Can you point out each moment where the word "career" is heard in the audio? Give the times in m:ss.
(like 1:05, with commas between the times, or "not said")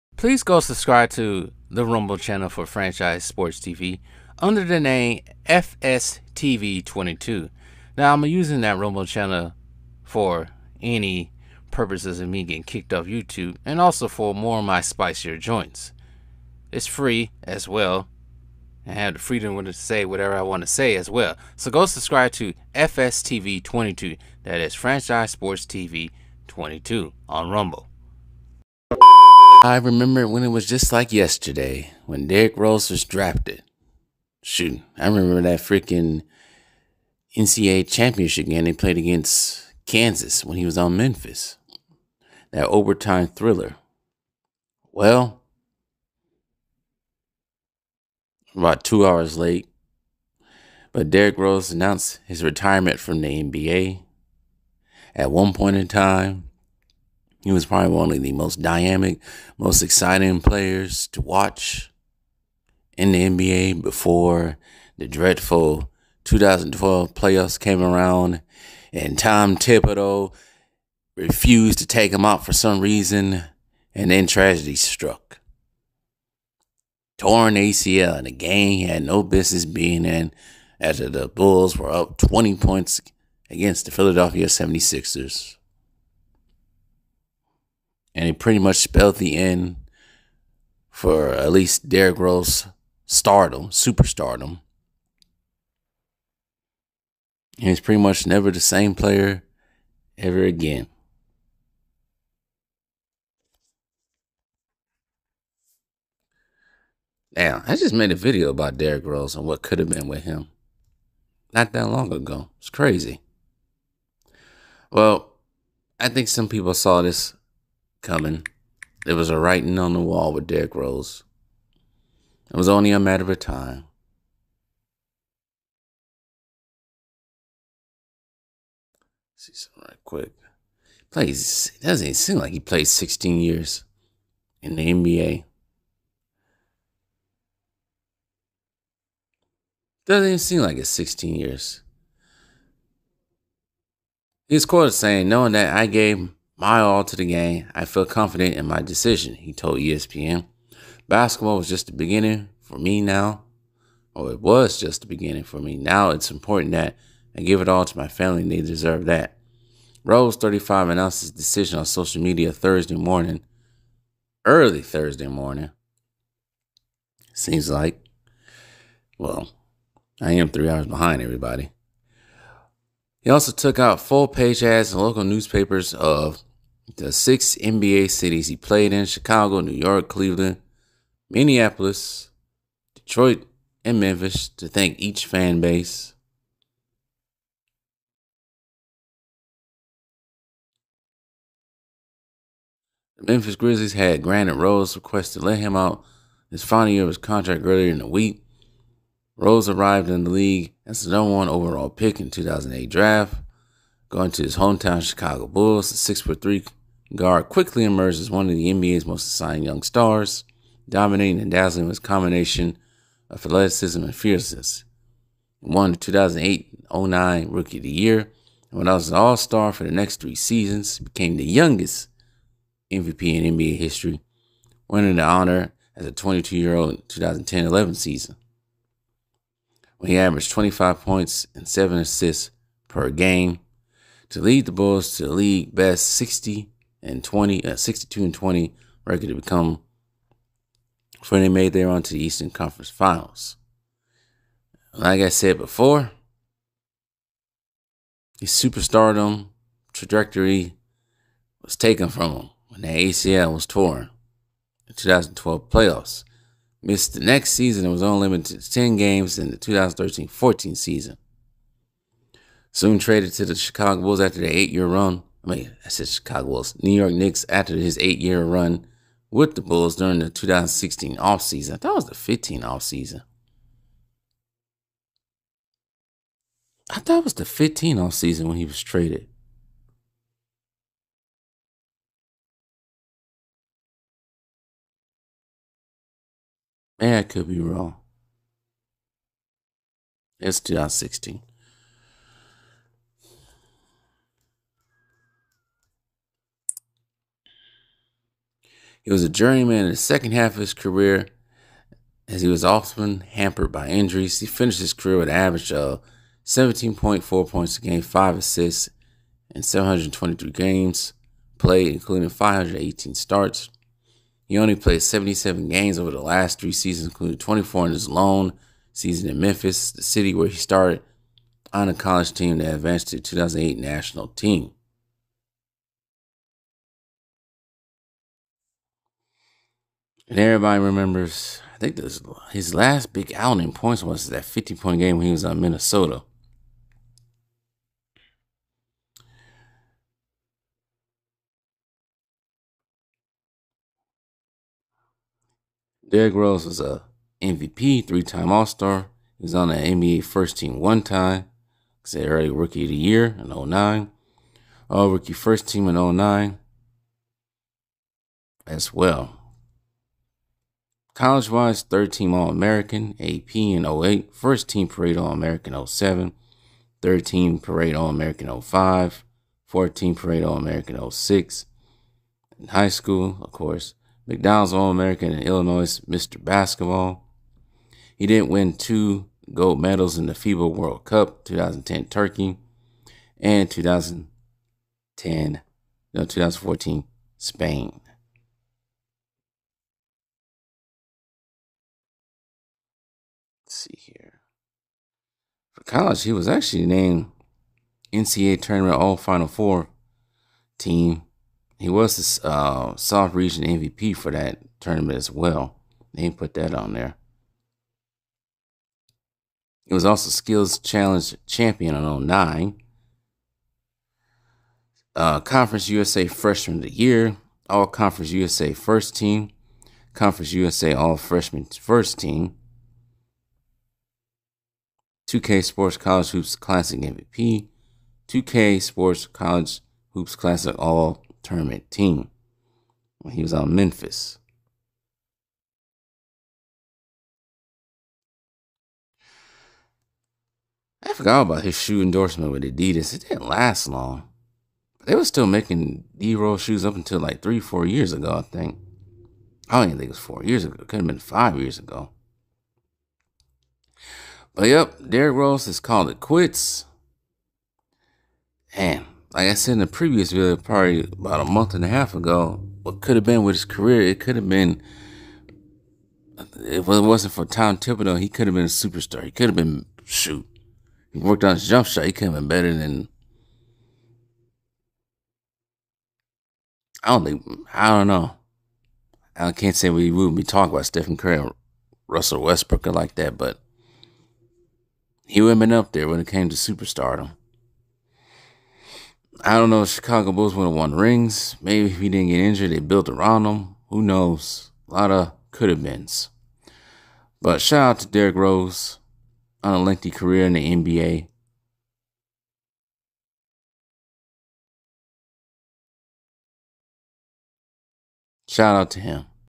5:00, 5:04, 7:43, 8:20.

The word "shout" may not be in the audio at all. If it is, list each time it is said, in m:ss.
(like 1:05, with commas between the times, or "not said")
8:17, 8:28.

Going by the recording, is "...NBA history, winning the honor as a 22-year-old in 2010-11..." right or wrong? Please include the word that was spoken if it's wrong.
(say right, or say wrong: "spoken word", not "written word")
right.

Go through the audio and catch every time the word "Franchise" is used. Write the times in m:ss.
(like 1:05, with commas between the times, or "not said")
0:02, 0:24.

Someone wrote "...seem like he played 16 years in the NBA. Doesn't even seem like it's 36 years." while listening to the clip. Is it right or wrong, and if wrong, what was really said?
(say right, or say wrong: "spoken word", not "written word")
wrong: "16", not "36".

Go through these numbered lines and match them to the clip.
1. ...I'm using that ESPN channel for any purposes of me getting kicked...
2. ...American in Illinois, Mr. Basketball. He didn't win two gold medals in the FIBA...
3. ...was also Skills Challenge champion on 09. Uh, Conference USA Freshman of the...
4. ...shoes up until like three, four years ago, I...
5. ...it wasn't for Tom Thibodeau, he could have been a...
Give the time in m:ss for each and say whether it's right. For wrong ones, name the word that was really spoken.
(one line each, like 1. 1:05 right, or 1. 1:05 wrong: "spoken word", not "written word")
1. 0:08 wrong: "Rumble", not "ESPN"
2. 6:14 right
3. 6:49 right
4. 7:26 right
5. 7:46 right.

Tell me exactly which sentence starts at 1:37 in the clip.
And he's pretty much never the same player ever again.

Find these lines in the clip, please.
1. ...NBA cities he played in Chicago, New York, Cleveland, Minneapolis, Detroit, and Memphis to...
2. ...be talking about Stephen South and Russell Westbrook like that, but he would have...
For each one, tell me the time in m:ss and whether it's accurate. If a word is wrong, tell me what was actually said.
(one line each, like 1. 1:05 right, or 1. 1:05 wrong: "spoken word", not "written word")
1. 2:57 right
2. 8:00 wrong: "Curry", not "South".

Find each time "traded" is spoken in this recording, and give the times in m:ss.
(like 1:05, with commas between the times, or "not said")
4:22, 4:38.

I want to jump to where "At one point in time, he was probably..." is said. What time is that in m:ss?
0:55.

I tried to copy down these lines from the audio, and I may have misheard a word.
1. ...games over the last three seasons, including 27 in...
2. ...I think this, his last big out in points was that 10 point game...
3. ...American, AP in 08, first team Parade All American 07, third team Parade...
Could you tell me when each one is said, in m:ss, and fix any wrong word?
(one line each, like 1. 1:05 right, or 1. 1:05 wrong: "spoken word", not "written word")
1. 5:15 wrong: "24", not "27"
2. 5:31 wrong: "50", not "10"
3. 6:02 right.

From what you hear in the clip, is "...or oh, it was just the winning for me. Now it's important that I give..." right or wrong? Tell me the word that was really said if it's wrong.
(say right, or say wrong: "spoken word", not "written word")
wrong: "beginning", not "winning".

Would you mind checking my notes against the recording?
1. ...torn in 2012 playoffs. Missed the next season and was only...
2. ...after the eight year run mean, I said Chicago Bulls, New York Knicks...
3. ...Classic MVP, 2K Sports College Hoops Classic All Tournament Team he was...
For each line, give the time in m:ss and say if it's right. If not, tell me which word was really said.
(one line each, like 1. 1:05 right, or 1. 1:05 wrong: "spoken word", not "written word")
1. 4:13 right
2. 4:24 right
3. 7:06 right.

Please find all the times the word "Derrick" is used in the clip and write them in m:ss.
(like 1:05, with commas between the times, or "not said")
0:32, 0:51, 1:31, 1:48, 2:00, 5:46, 7:35, 8:18.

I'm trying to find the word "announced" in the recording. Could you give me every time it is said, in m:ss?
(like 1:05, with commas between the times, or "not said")
0:51, 2:40.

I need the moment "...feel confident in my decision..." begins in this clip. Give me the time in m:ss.
2:27.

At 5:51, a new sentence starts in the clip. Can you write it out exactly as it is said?
I said early rookie of the year in 09.